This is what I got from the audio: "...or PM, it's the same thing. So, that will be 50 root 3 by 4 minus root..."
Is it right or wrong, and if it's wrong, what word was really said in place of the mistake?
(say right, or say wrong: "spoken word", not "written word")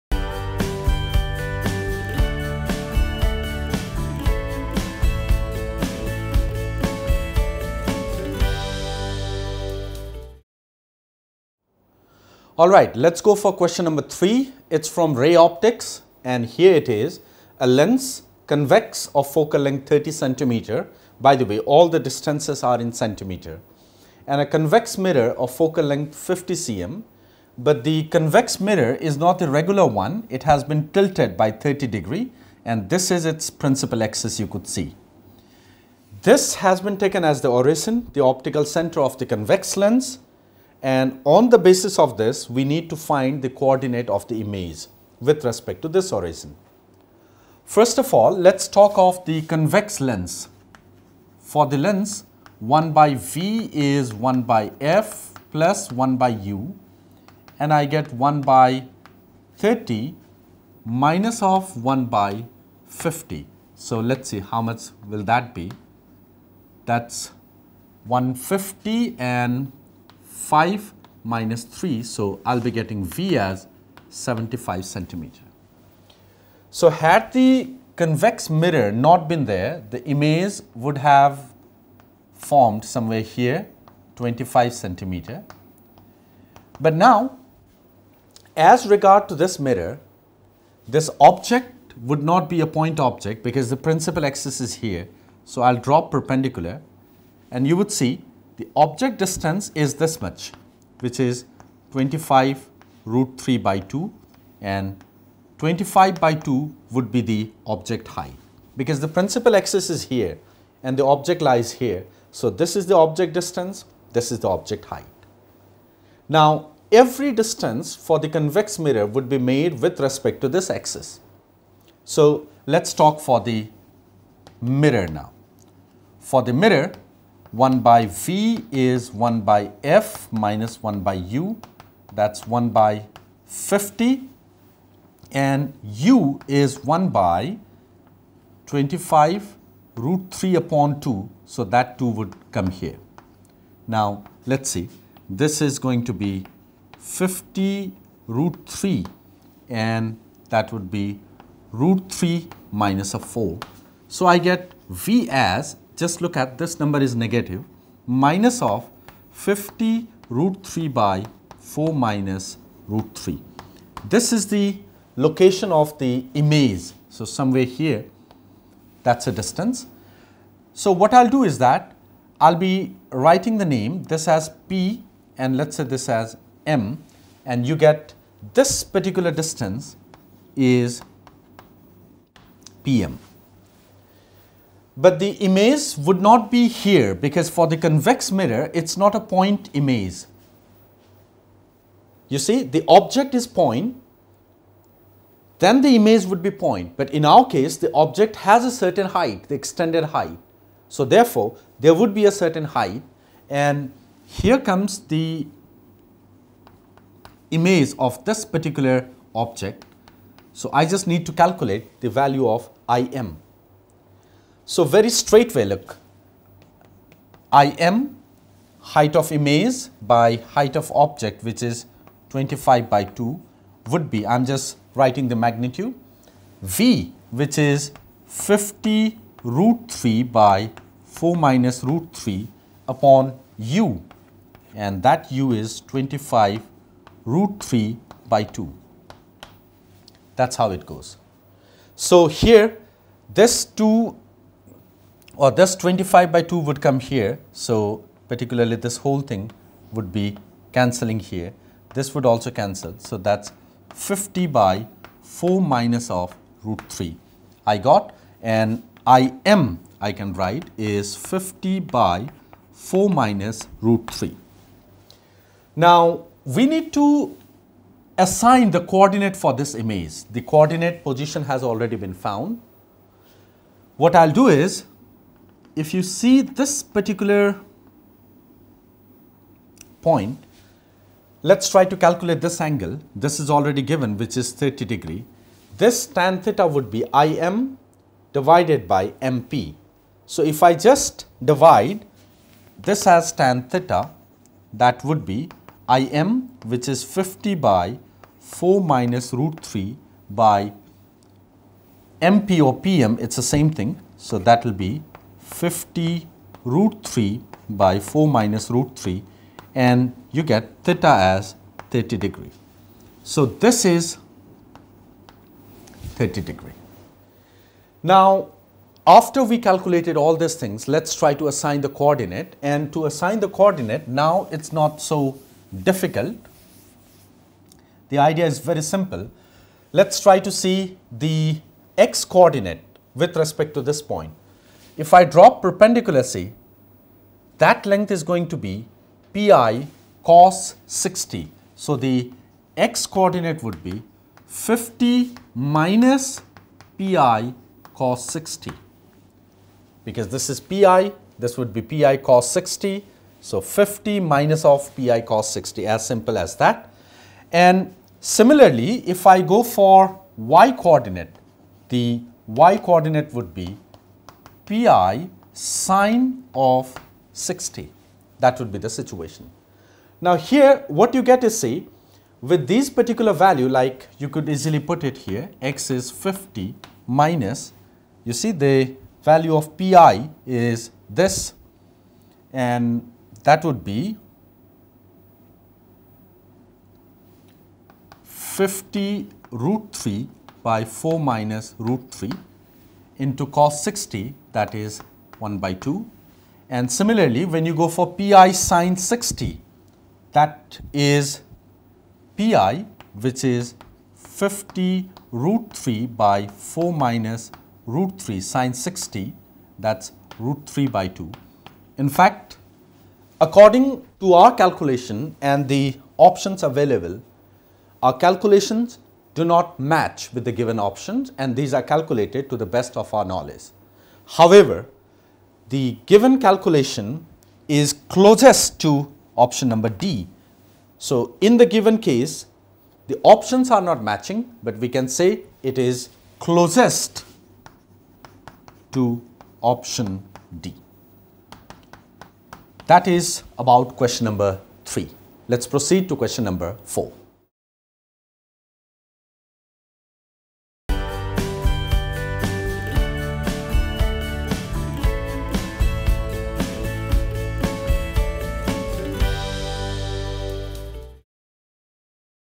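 right.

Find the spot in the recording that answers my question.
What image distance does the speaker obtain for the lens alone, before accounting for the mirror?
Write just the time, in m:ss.
1:14.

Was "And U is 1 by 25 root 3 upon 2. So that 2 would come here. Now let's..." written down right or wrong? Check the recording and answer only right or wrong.
right.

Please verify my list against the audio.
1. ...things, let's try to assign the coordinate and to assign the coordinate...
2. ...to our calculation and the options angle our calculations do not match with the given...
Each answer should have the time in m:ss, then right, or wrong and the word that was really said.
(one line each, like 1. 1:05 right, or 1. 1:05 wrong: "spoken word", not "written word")
1. 5:20 right
2. 6:54 wrong: "available", not "angle".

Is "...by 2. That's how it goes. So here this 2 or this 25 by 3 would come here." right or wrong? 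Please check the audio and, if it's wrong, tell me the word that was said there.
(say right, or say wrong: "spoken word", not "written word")
wrong: "2", not "3".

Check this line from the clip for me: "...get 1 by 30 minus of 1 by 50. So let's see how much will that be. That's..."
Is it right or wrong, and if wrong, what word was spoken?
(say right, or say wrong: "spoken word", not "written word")
right.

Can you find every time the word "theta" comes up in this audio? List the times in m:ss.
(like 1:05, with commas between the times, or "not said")
4:46, 4:53, 5:10.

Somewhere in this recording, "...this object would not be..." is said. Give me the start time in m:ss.
1:30.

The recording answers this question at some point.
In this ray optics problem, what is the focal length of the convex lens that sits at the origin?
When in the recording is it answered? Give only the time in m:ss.
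0:19.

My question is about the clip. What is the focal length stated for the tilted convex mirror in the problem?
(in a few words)
50 cm.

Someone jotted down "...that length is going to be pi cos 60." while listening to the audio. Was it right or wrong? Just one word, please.
right.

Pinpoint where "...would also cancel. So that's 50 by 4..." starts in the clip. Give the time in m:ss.
4:12.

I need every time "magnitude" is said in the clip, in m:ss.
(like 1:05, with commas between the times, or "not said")
3:45.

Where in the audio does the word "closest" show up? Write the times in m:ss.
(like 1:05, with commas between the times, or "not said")
7:08, 7:16.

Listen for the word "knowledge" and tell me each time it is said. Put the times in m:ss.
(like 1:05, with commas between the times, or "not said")
7:03.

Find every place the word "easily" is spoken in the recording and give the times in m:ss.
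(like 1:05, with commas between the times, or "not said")
6:14.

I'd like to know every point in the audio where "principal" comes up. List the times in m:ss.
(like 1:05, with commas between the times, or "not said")
0:33, 1:33, 1:49.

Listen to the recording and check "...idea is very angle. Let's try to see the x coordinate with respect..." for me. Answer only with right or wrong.
wrong.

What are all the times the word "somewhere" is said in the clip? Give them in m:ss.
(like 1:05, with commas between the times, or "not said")
1:22, 2:47.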